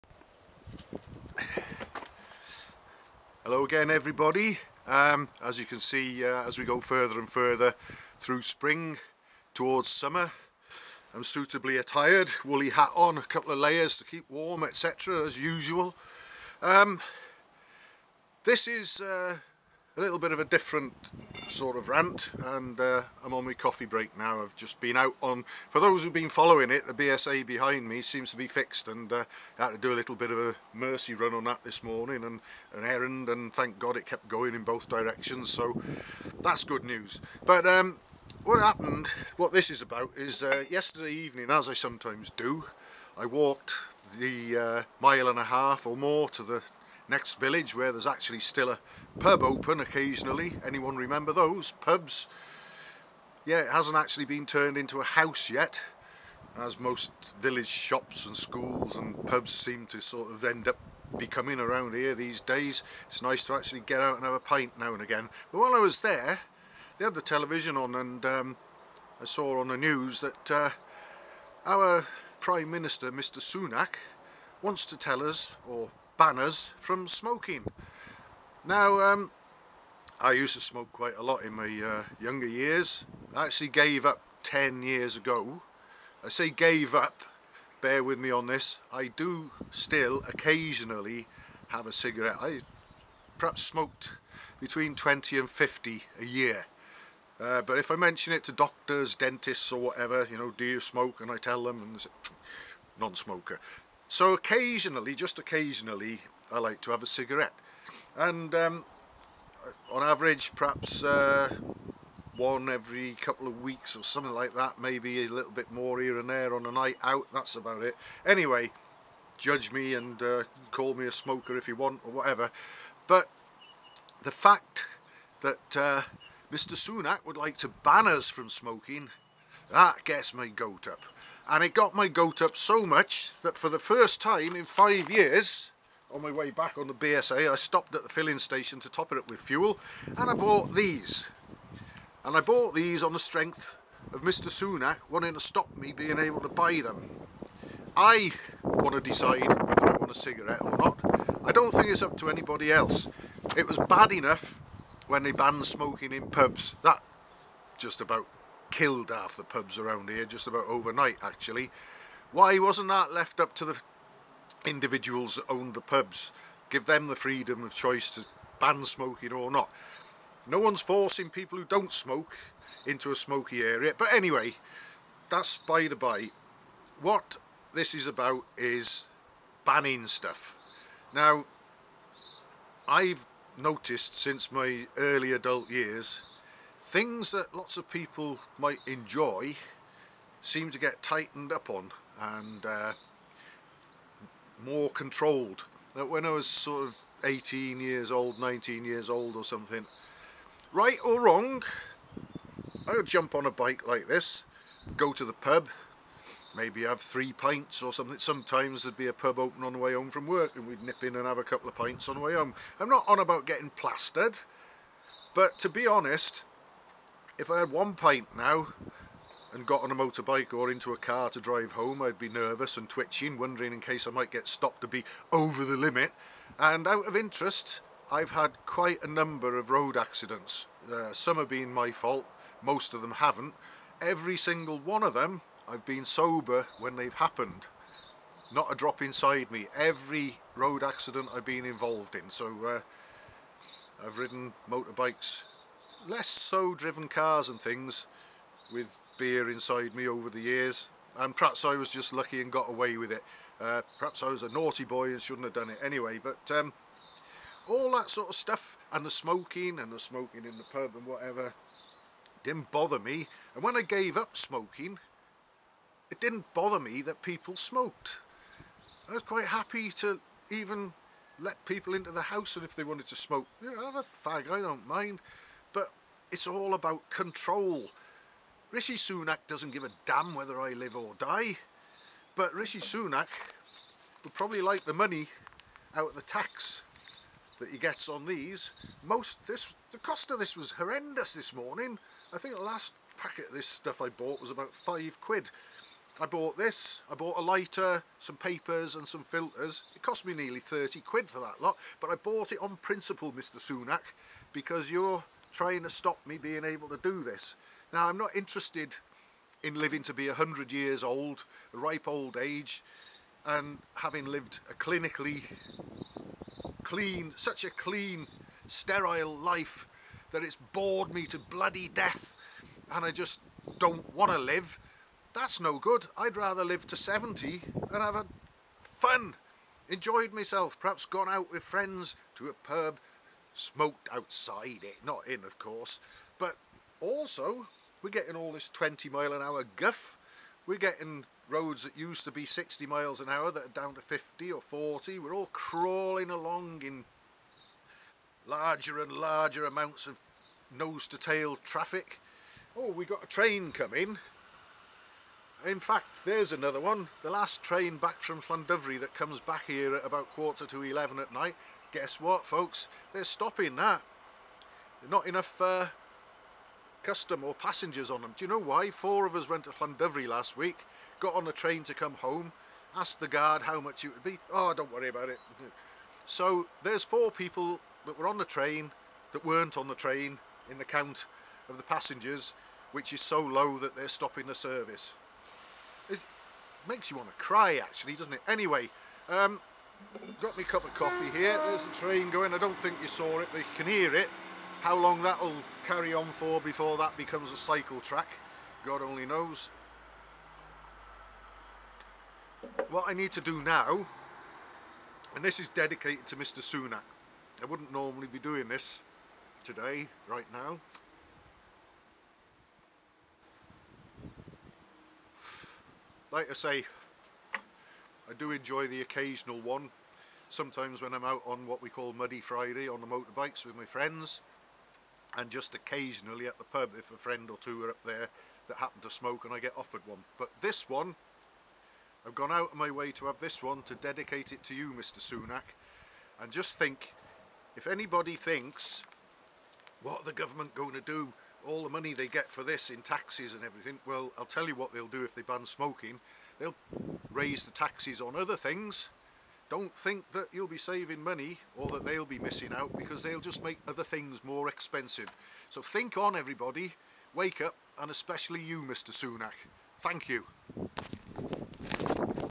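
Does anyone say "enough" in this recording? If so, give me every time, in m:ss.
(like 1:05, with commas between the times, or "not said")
2:34, 6:05.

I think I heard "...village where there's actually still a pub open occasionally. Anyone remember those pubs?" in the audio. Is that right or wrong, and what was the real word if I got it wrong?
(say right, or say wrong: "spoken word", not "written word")
right.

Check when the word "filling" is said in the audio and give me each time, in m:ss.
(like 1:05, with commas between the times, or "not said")
2:18.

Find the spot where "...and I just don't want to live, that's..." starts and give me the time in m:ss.
5:22.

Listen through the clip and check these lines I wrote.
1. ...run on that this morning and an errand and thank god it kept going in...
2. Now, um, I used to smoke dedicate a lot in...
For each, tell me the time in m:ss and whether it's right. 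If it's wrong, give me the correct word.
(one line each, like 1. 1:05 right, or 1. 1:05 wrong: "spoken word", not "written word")
1. 0:31 right
2. 1:18 wrong: "quite", not "dedicate".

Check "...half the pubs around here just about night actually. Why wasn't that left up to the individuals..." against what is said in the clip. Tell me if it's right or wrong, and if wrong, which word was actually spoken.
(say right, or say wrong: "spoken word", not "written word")
wrong: "overnight", not "night".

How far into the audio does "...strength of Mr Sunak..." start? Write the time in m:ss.
2:23.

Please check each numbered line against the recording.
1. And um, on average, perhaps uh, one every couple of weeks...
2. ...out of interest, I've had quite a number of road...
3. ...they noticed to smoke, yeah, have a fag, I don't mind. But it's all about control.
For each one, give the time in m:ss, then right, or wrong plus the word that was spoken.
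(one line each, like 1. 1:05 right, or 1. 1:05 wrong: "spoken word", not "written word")
1. 1:48 right
2. 3:46 right
3. 4:32 wrong: "wanted", not "noticed".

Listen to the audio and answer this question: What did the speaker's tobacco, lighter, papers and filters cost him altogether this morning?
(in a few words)
nearly £30.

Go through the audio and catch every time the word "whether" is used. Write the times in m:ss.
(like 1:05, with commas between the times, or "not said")
2:29, 4:40.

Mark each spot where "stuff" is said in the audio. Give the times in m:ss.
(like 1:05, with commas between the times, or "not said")
3:00, 4:18, 4:53.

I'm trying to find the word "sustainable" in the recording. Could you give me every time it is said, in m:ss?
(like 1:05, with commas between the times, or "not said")
not said.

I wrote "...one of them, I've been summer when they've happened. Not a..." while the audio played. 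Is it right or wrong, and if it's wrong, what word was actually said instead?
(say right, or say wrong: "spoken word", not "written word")
wrong: "sober", not "summer".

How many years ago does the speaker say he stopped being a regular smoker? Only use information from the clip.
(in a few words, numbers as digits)
10 years.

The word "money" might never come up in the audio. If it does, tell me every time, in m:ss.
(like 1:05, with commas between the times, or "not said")
4:44, 7:21, 7:31.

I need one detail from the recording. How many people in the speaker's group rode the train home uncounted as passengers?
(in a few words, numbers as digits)
4.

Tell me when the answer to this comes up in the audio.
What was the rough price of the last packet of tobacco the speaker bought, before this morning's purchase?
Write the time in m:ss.
4:54.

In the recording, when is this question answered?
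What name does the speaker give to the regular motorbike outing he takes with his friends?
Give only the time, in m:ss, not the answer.
7:02.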